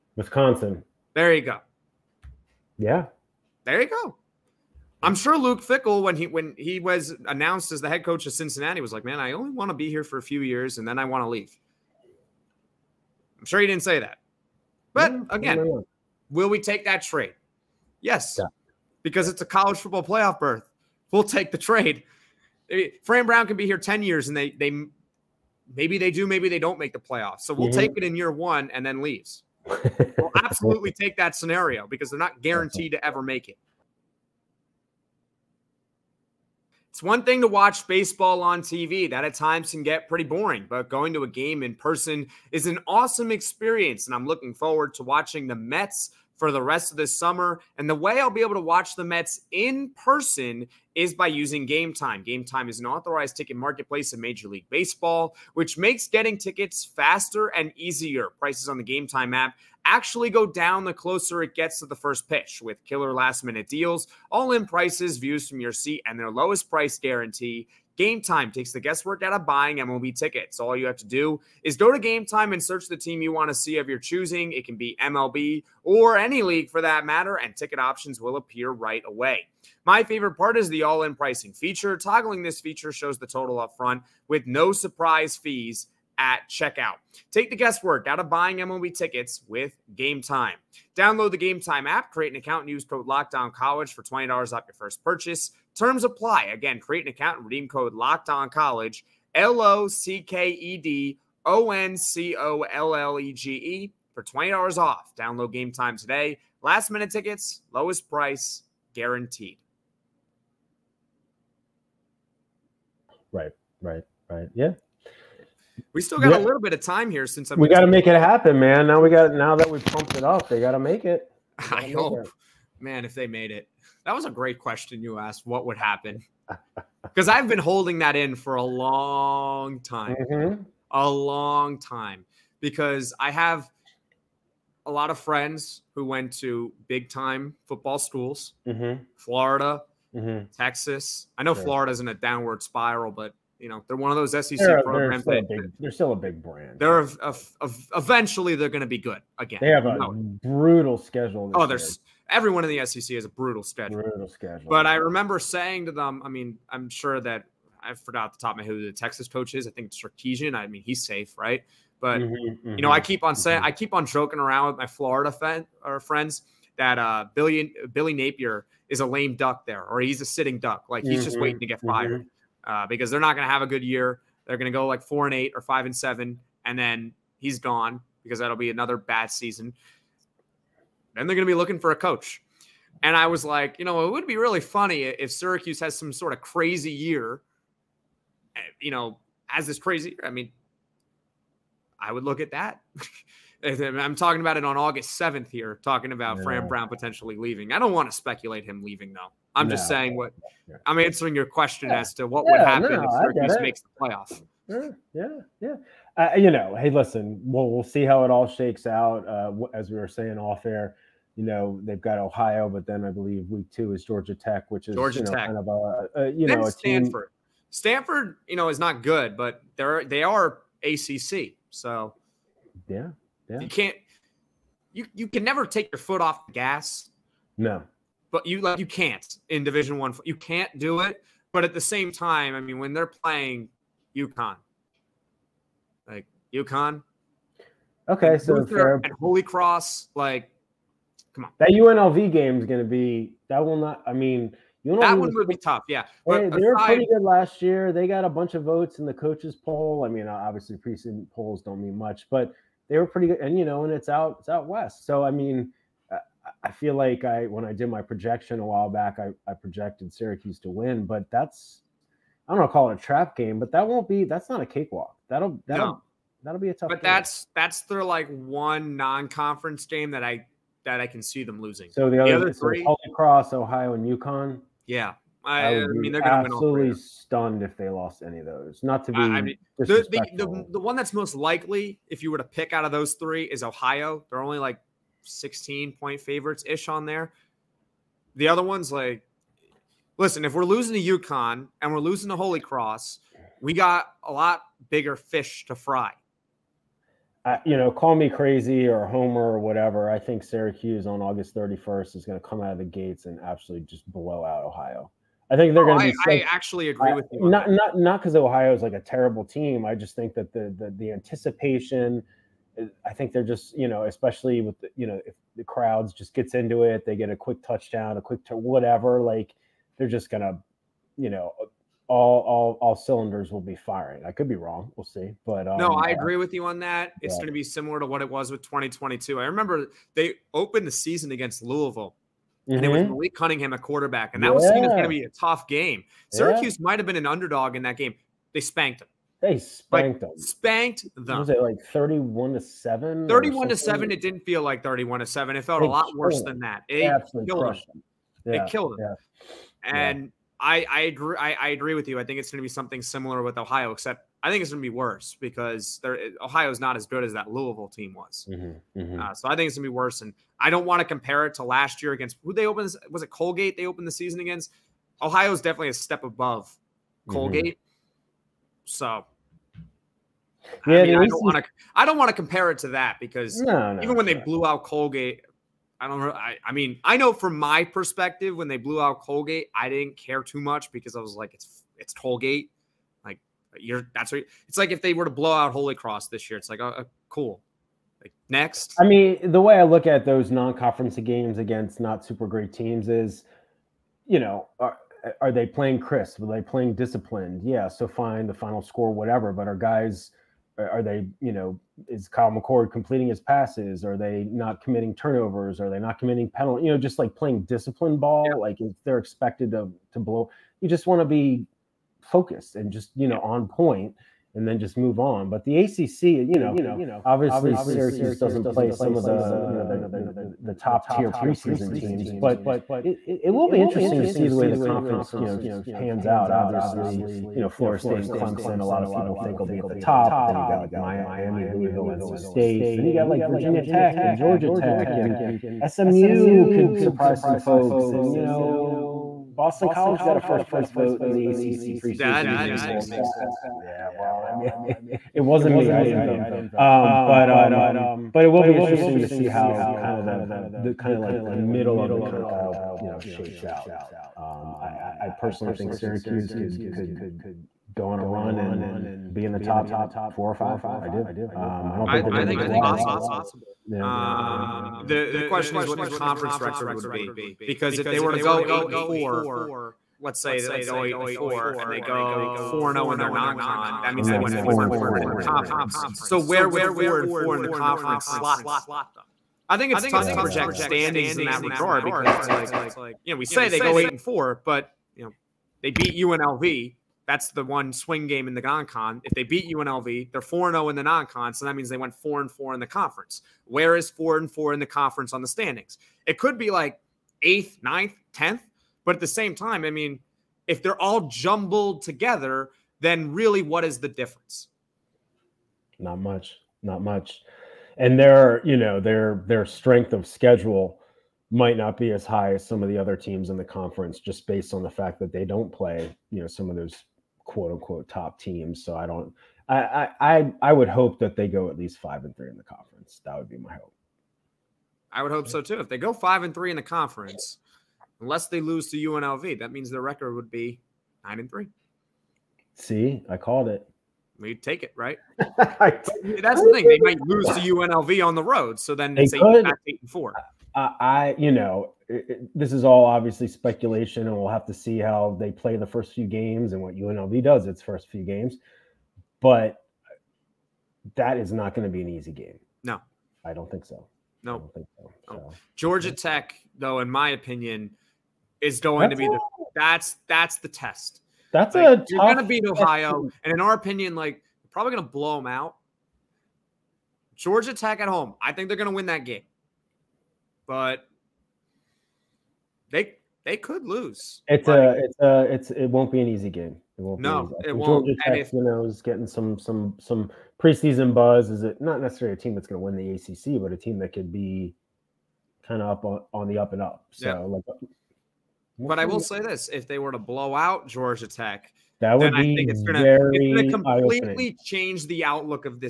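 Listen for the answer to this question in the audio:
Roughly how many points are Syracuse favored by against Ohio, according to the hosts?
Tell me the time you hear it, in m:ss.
4:45.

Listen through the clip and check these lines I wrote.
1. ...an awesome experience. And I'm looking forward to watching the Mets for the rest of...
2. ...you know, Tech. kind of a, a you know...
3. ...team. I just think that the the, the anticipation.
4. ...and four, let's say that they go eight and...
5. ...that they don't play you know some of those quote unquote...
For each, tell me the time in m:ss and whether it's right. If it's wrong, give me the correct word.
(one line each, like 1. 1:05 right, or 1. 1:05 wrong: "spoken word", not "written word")
1. 0:42 right
2. 3:35 right
3. 5:09 right
4. 7:48 right
5. 8:35 right.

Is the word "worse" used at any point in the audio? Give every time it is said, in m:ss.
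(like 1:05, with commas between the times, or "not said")
5:46, 5:54, 5:59.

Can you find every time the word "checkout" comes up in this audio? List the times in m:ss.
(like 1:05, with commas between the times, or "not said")
1:26.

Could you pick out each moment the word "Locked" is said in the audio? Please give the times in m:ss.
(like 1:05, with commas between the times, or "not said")
1:33, 1:37.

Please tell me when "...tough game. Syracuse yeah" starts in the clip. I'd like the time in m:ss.
5:35.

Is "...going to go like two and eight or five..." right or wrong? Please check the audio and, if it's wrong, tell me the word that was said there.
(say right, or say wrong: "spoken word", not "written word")
wrong: "four", not "two".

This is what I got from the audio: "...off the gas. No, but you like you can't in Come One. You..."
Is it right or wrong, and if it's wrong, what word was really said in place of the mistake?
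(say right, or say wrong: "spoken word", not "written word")
wrong: "Division", not "Come".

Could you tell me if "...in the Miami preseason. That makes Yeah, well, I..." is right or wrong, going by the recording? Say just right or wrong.
wrong.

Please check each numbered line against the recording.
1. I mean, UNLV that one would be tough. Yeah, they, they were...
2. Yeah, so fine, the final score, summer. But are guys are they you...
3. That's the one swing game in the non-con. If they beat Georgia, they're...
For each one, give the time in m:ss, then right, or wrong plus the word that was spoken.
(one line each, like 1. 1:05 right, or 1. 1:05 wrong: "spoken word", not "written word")
1. 4:04 right
2. 6:37 wrong: "whatever", not "summer"
3. 8:07 wrong: "UNLV", not "Georgia".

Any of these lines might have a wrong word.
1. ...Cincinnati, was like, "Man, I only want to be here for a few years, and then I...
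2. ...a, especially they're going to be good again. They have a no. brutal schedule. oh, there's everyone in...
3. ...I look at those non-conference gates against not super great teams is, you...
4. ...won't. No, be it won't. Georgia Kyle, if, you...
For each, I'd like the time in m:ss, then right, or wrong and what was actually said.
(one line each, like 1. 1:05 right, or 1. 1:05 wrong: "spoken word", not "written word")
1. 0:08 right
2. 2:27 wrong: "eventually", not "especially"
3. 6:29 wrong: "games", not "gates"
4. 9:37 wrong: "Tech", not "Kyle".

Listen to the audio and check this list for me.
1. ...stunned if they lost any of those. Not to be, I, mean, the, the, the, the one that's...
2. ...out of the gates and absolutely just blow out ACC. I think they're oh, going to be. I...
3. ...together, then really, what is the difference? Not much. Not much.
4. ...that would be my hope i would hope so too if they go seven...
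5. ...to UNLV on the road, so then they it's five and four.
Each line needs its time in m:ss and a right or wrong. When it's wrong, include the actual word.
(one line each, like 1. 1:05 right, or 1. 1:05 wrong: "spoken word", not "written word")
1. 4:36 right
2. 5:02 wrong: "Ohio", not "ACC"
3. 8:22 right
4. 8:43 wrong: "five", not "seven"
5. 8:57 wrong: "eight", not "five".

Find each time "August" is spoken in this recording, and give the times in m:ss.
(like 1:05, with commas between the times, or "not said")
3:14, 5:01.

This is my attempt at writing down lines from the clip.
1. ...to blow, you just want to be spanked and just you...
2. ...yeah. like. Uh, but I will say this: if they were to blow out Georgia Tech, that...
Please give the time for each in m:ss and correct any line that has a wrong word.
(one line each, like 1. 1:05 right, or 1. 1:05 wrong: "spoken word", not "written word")
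1. 6:50 wrong: "focused", not "spanked"
2. 9:47 right.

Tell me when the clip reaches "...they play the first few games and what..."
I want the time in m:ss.
9:05.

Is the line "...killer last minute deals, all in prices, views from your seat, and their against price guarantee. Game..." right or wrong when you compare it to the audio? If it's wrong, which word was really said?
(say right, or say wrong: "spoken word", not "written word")
wrong: "lowest", not "against".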